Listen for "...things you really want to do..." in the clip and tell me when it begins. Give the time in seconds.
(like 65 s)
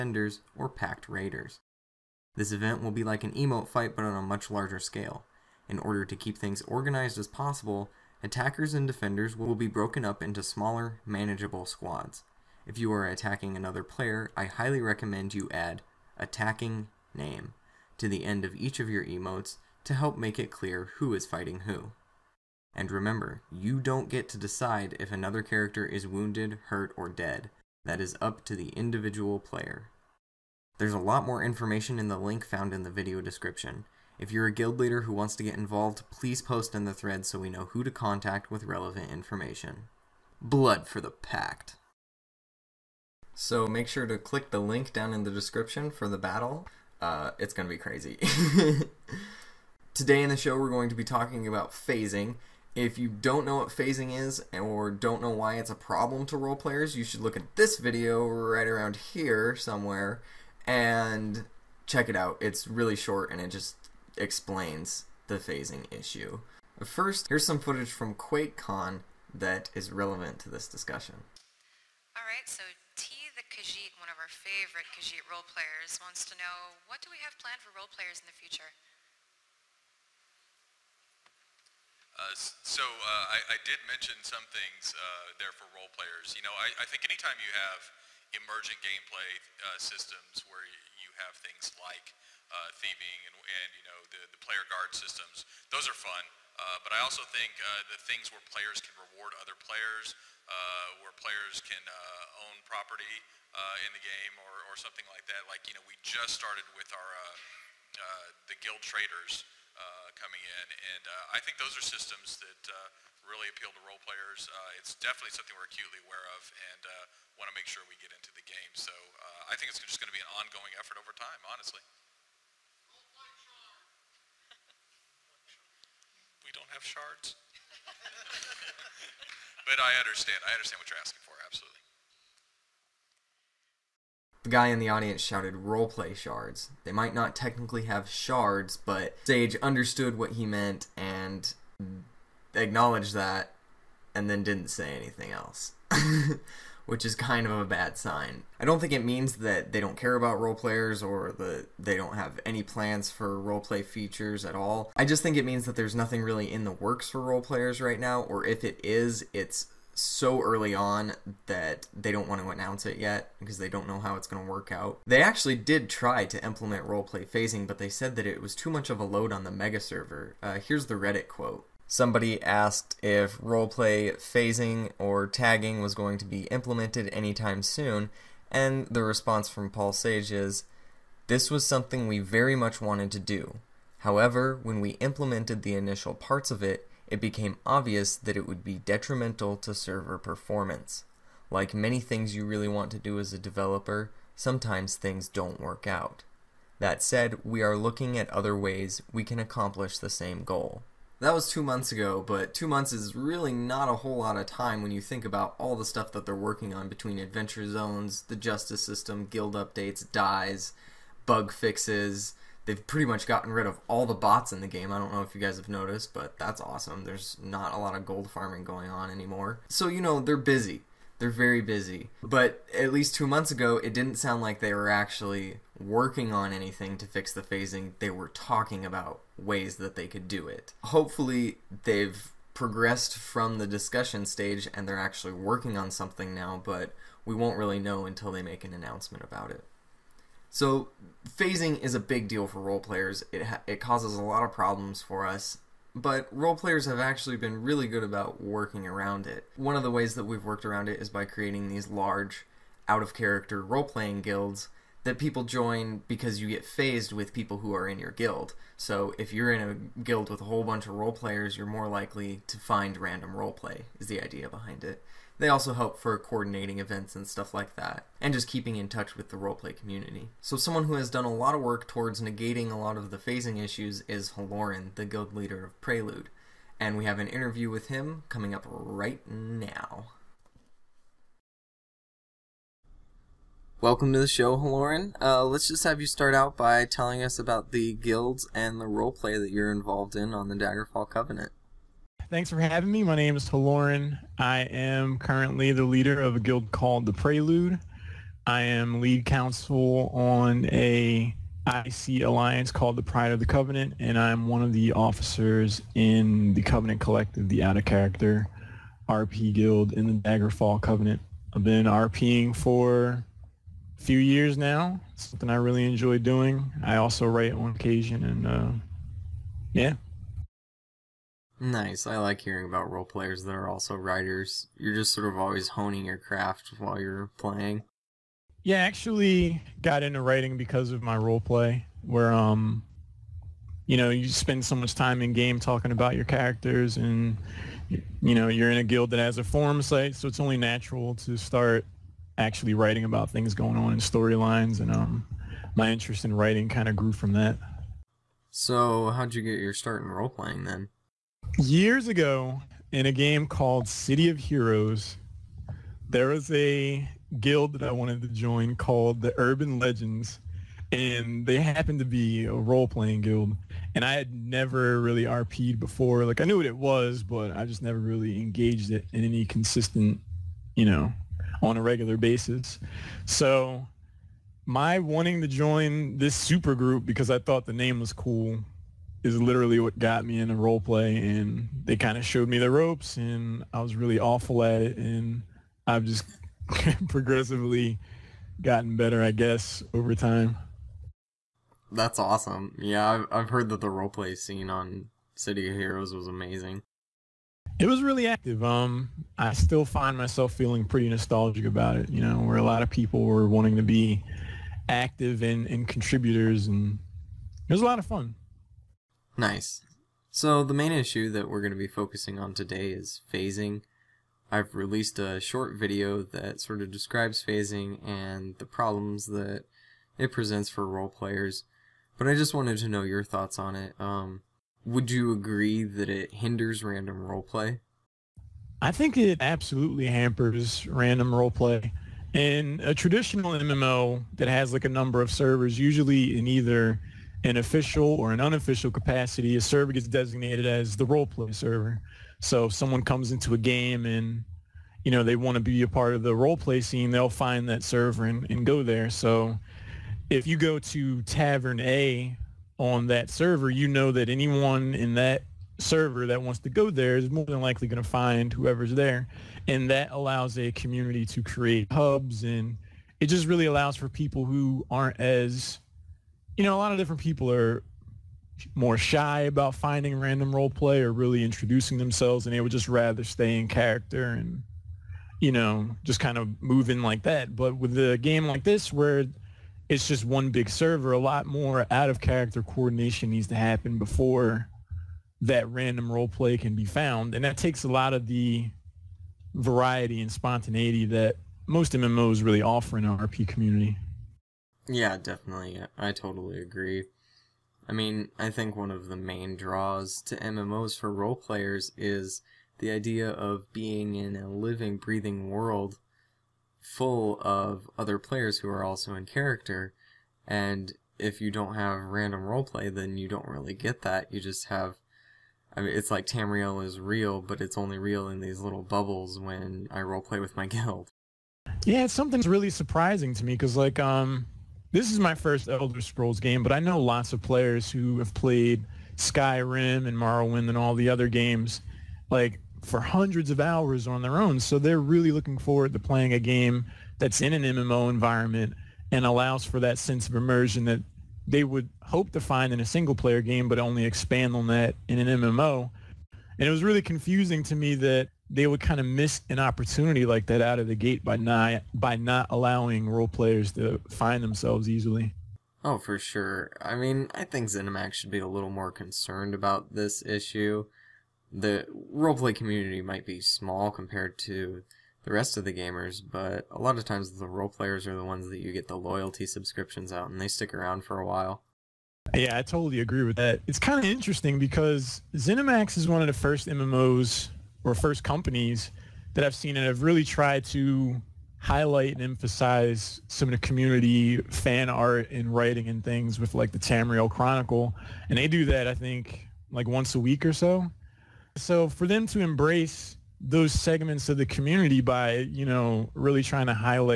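191 s.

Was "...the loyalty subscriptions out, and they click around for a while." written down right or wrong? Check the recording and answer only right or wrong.
wrong.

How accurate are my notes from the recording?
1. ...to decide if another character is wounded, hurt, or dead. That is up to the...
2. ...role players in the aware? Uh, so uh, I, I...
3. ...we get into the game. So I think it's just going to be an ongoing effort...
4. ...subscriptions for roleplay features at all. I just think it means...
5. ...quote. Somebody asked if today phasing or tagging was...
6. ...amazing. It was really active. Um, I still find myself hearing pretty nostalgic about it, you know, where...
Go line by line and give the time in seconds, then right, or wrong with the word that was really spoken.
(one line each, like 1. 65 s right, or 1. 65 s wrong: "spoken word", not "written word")
1. 24 s right
2. 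77 s wrong: "future", not "aware"
3. 117 s right
4. 152 s wrong: "plans", not "subscriptions"
5. 171 s wrong: "roleplay", not "today"
6. 396 s wrong: "feeling", not "hearing".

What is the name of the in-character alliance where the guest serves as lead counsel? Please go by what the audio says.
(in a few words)
Pride of the Covenant.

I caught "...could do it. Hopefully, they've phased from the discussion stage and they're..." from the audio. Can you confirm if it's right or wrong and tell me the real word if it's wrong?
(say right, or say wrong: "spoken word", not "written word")
wrong: "progressed", not "phased".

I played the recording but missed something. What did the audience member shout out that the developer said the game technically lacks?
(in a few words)
Roleplay shards.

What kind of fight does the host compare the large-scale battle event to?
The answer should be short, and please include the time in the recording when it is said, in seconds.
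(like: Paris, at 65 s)
An emote fight, at 3 s.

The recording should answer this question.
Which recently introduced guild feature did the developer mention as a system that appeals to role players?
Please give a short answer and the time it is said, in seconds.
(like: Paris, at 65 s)
Guild traders, at 108 s.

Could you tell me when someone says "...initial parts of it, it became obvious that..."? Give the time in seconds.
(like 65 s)
185 s.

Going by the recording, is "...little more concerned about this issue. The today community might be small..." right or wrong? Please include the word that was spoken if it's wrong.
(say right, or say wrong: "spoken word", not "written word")
wrong: "roleplay", not "today".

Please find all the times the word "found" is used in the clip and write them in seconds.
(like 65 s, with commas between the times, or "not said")
32 s, 486 s.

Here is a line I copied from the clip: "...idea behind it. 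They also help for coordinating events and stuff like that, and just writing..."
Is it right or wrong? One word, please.
wrong.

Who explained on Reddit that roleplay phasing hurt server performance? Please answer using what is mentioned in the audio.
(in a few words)
Paul Sage.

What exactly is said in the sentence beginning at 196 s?
That said, we are looking at other ways we can accomplish the same goal.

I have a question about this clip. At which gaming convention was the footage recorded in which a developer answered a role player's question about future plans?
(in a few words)
QuakeCon.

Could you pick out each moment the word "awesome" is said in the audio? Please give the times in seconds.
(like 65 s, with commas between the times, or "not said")
216 s, 392 s.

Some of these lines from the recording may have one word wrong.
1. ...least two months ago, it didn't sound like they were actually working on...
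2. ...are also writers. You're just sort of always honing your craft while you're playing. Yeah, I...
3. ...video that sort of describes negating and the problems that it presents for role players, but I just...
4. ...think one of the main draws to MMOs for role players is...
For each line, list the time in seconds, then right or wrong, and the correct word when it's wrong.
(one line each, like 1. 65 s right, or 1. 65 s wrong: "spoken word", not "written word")
1. 222 s right
2. 323 s right
3. 415 s wrong: "phasing", not "negating"
4. 498 s right.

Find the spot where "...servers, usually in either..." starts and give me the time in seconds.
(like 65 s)
435 s.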